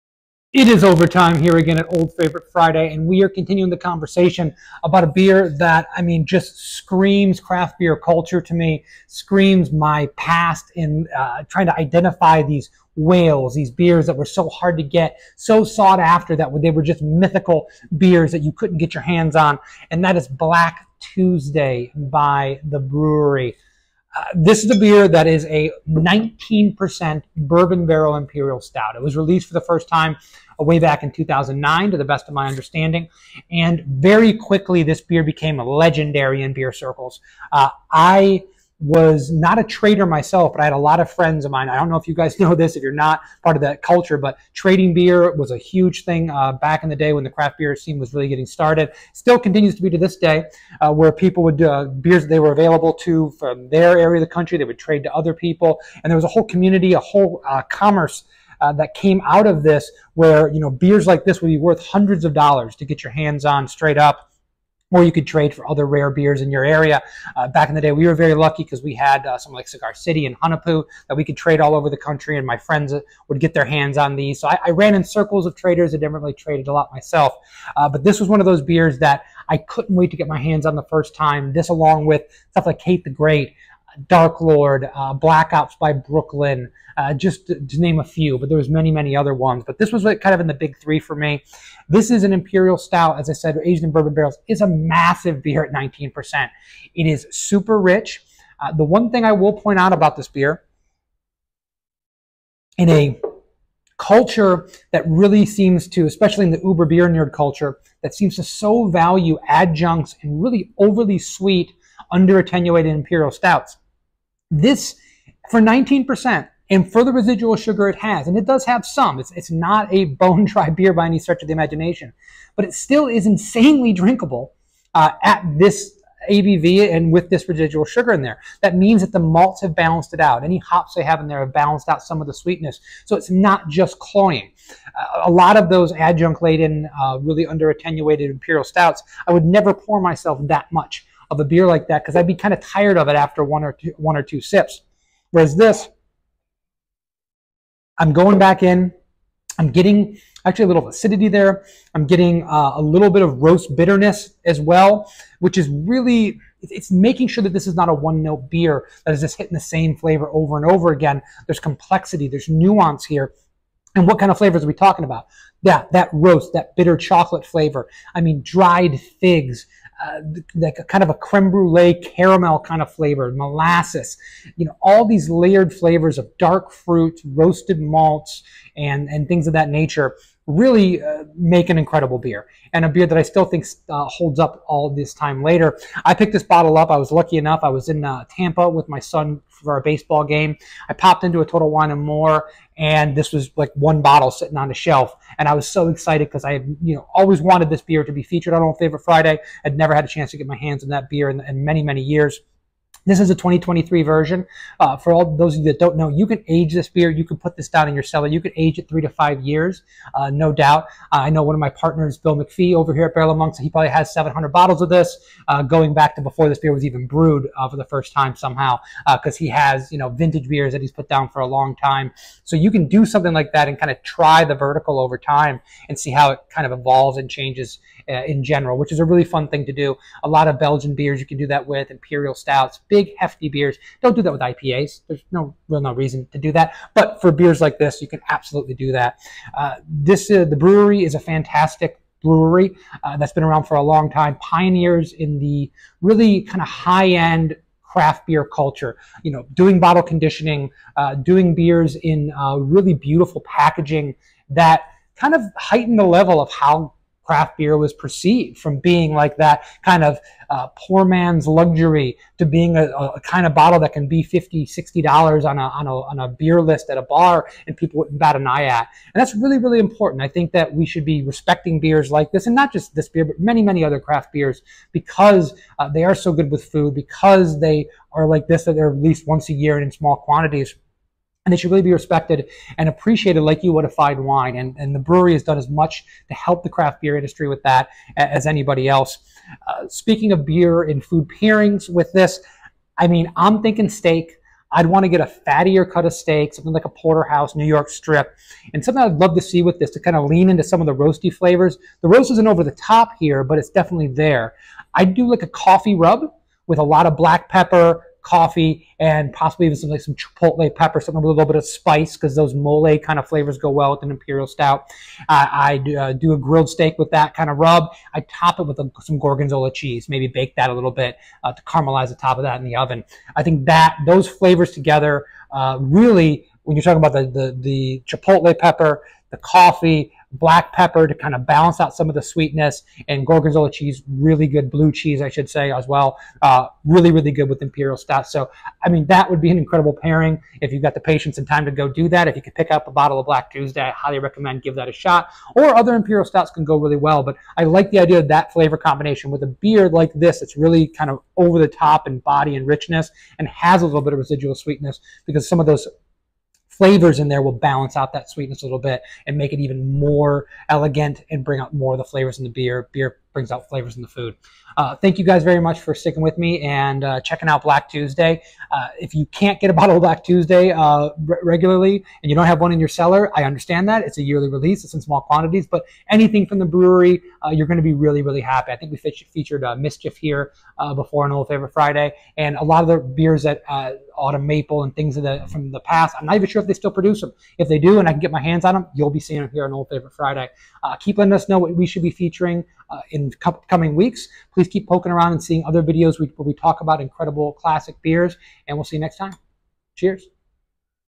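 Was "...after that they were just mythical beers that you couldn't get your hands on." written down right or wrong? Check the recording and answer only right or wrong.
right.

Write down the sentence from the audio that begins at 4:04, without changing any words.
Pioneers in the really kind of high end craft beer culture.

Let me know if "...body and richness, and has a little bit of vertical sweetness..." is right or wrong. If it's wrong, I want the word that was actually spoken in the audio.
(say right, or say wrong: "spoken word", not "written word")
wrong: "residual", not "vertical".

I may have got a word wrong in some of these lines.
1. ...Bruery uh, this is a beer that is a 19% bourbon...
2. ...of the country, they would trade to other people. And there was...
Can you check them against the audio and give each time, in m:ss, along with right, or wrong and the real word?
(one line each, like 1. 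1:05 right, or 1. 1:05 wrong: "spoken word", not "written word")
1. 0:22 right
2. 0:54 right.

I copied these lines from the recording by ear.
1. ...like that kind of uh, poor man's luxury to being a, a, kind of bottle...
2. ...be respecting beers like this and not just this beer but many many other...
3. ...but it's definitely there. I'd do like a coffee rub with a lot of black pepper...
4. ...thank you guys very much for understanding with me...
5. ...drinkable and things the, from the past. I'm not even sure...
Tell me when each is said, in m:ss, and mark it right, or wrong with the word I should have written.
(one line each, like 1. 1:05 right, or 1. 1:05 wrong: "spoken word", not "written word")
1. 4:19 right
2. 4:31 right
3. 5:03 right
4. 6:04 wrong: "sticking", not "understanding"
5. 6:24 wrong: "maple", not "drinkable".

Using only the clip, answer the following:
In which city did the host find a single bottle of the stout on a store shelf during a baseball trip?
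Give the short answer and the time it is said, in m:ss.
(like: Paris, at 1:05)
Tampa, at 3:08.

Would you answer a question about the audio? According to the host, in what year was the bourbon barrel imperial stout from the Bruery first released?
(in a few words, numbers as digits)
2009.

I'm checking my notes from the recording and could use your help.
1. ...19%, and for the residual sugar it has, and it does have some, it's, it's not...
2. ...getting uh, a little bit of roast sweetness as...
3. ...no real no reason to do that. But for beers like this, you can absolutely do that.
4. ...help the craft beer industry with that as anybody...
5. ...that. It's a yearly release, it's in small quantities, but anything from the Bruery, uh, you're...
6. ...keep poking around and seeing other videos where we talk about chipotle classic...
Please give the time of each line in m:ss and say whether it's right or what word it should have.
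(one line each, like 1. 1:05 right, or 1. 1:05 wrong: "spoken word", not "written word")
1. 1:55 right
2. 2:32 wrong: "bitterness", not "sweetness"
3. 3:55 right
4. 4:46 right
5. 6:13 right
6. 6:34 wrong: "incredible", not "chipotle".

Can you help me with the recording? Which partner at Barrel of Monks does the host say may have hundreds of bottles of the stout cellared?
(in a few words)
Bill McPhee.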